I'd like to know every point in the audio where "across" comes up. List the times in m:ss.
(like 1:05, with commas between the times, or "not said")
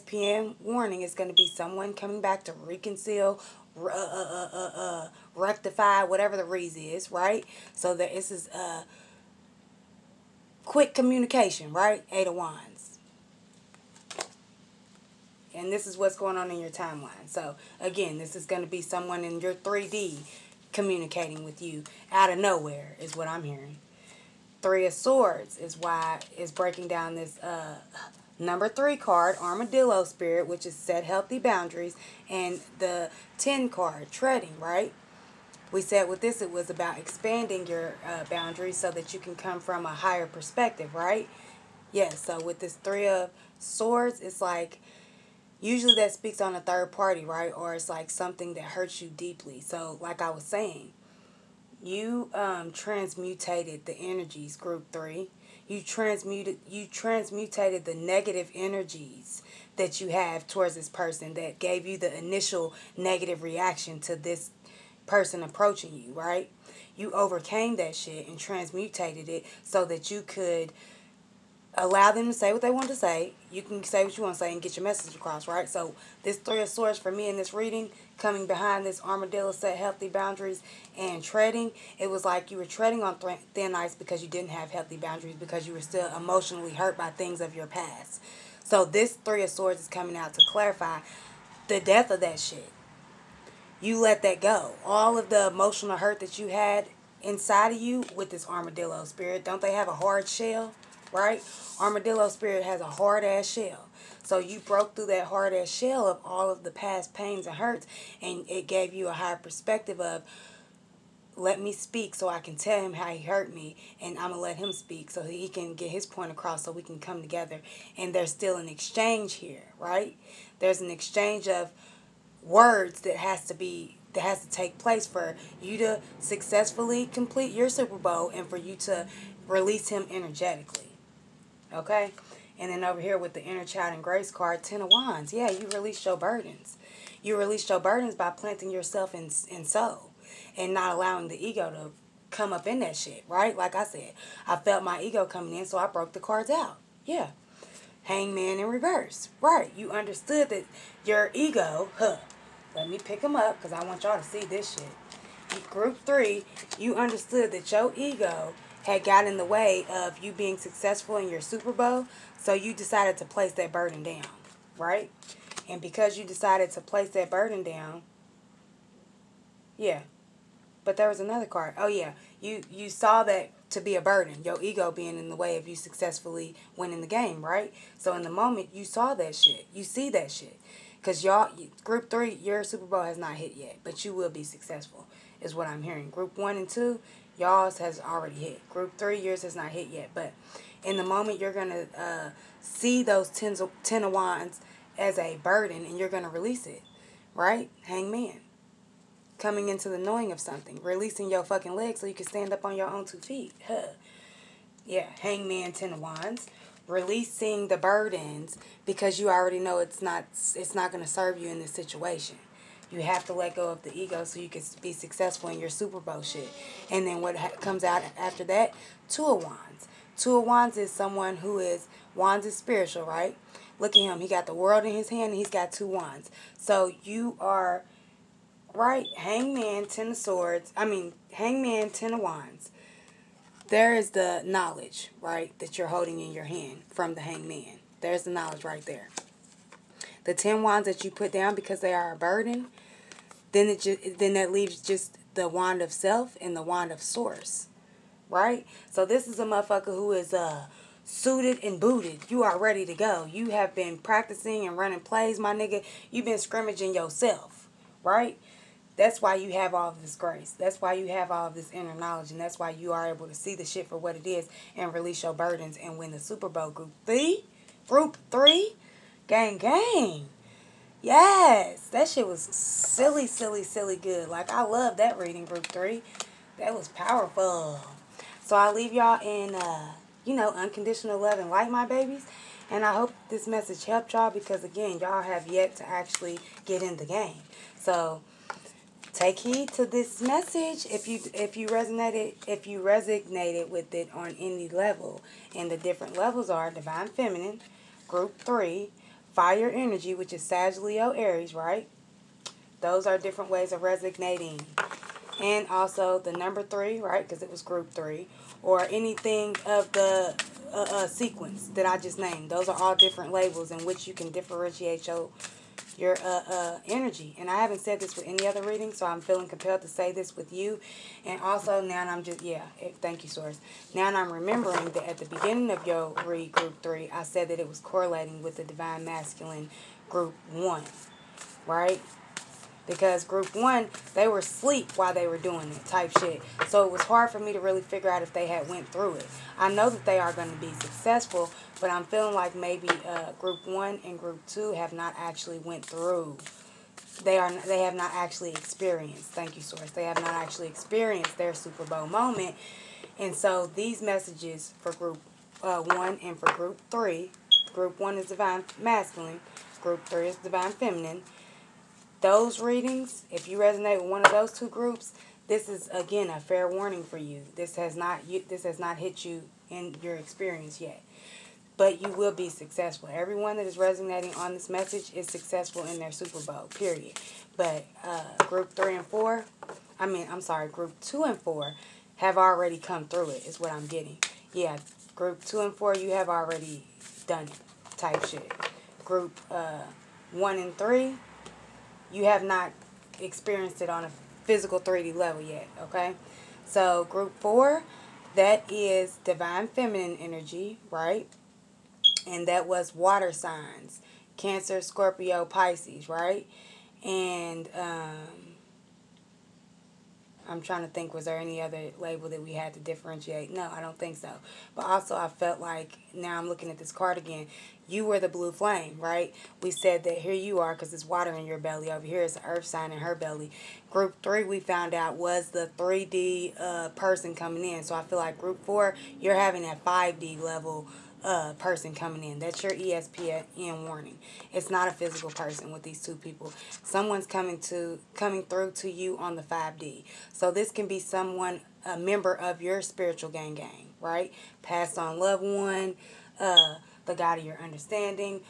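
1:15, 1:56.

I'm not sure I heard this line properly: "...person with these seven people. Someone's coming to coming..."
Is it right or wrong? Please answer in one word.
wrong.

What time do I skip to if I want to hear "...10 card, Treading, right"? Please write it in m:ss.
0:33.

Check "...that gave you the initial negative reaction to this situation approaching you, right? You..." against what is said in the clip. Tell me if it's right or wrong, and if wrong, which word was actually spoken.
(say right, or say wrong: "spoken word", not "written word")
wrong: "person", not "situation".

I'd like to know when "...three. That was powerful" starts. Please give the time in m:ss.
4:35.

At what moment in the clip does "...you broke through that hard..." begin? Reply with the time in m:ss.
1:44.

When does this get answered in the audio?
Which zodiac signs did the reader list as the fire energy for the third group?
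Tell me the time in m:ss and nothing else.
5:00.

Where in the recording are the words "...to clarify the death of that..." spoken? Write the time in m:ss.
1:30.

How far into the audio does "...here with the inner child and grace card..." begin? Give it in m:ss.
2:13.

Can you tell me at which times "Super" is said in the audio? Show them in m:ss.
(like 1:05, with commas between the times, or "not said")
2:07, 2:41, 3:02, 3:35, 4:26, 5:51, 6:16.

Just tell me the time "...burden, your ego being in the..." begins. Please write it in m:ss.
2:54.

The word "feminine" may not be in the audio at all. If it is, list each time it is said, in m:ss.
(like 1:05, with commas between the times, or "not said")
4:57, 6:00, 6:39.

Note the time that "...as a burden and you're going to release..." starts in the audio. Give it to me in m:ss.
3:14.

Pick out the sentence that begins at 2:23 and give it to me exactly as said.
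Like I said, I felt my ego coming in, so I broke the cards out.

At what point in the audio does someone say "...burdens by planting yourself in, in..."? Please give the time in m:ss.
2:17.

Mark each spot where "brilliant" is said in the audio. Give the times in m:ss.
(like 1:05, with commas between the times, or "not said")
not said.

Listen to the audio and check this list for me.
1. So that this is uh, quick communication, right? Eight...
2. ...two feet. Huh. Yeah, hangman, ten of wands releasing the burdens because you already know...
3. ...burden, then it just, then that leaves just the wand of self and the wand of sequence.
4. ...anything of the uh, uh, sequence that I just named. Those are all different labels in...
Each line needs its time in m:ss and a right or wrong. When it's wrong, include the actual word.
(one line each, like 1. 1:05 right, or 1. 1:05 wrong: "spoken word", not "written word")
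1. 0:07 right
2. 3:23 right
3. 4:02 wrong: "source", not "sequence"
4. 5:08 right.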